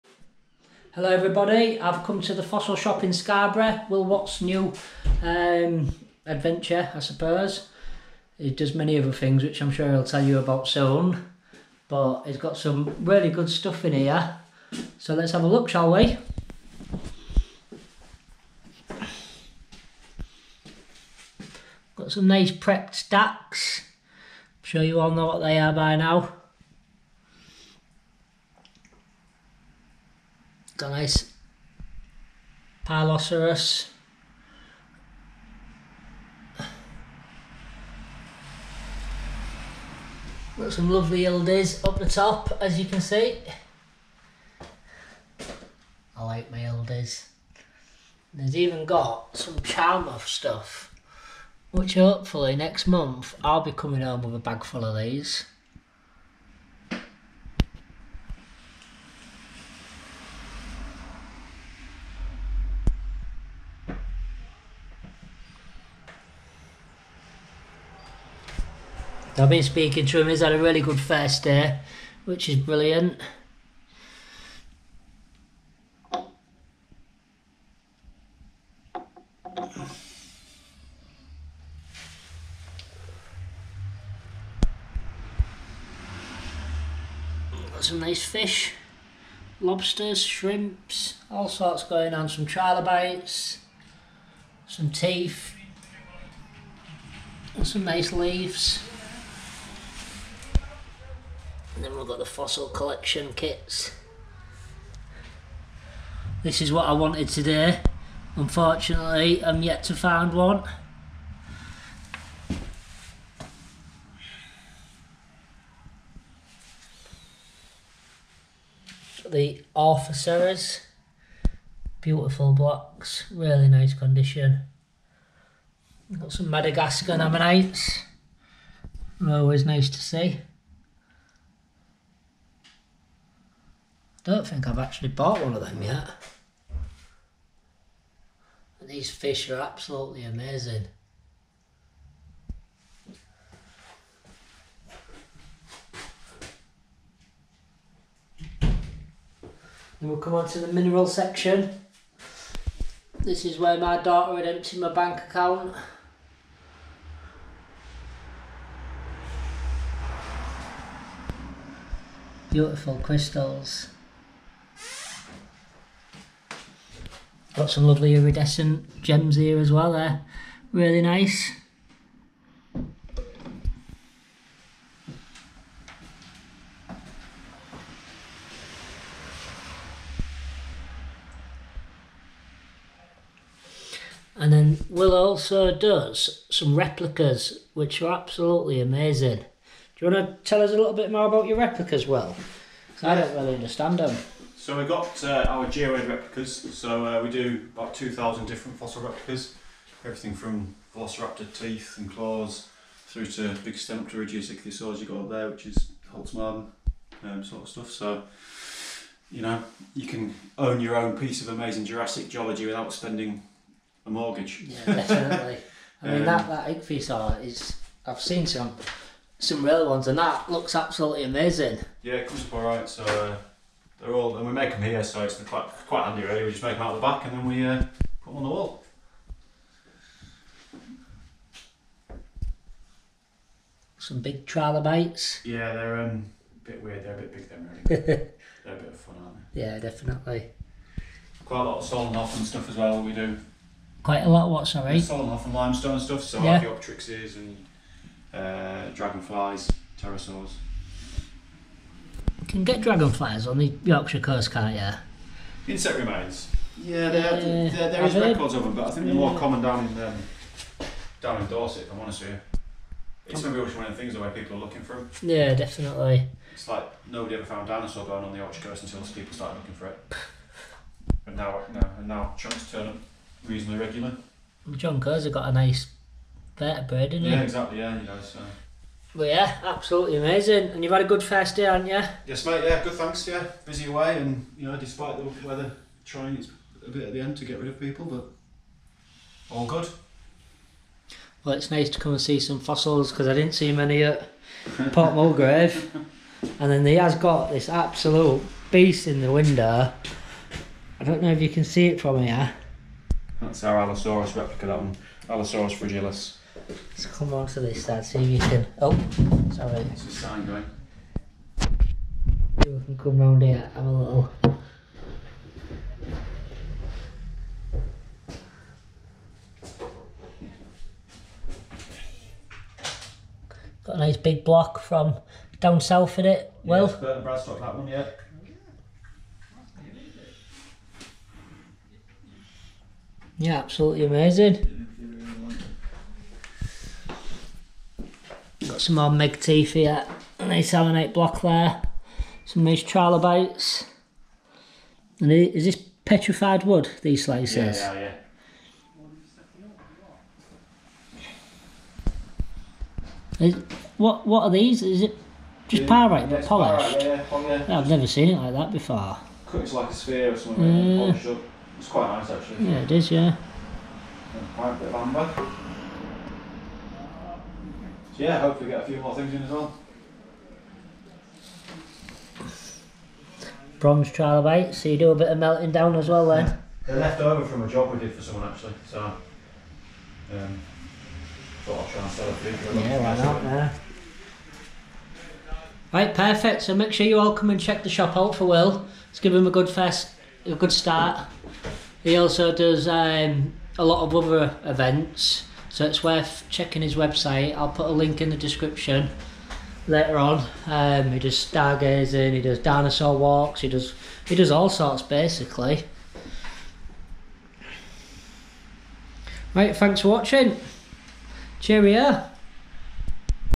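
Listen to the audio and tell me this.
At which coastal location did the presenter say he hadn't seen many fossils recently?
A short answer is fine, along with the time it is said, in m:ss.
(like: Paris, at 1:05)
Port Mulgrave, at 4:54.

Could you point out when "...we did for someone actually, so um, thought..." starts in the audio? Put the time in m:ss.
6:17.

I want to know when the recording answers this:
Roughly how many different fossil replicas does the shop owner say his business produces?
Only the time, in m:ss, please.
3:17.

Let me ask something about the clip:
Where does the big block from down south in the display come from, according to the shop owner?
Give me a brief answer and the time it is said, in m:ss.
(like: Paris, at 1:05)
Burton Bradstock, at 5:26.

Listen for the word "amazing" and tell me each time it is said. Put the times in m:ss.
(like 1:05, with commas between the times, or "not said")
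2:20, 3:08, 3:31, 3:41, 4:40, 5:34.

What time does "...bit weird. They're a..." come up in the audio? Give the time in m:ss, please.
3:56.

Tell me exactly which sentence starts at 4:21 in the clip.
If I'm honest with you, it's maybe one of the things the way people are looking for them.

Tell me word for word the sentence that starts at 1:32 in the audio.
Some trilobites, some teeth, and some nice leaves.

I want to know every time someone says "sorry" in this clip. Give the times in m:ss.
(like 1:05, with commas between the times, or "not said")
4:04, 5:09.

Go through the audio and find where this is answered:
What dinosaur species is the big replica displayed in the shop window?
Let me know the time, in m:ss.
5:05.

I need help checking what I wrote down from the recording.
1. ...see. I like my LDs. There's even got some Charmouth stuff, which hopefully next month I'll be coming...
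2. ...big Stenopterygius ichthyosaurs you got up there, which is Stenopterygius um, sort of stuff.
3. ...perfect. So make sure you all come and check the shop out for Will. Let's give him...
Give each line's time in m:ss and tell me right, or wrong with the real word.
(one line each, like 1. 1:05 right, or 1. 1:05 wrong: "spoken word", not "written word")
1. 0:42 right
2. 3:23 wrong: "Holzmaden", not "Stenopterygius"
3. 6:26 right.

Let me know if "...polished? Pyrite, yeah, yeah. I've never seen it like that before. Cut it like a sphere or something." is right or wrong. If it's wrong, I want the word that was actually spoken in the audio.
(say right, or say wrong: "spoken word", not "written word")
right.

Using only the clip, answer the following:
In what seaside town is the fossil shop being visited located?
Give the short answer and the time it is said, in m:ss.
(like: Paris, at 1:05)
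Scarborough, at 0:03.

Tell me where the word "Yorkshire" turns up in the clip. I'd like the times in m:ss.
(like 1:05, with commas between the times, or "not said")
4:13, 4:28.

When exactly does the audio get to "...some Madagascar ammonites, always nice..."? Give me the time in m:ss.
2:06.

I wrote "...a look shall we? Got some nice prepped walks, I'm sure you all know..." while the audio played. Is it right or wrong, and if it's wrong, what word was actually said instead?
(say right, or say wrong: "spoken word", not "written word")
wrong: "stacks", not "walks".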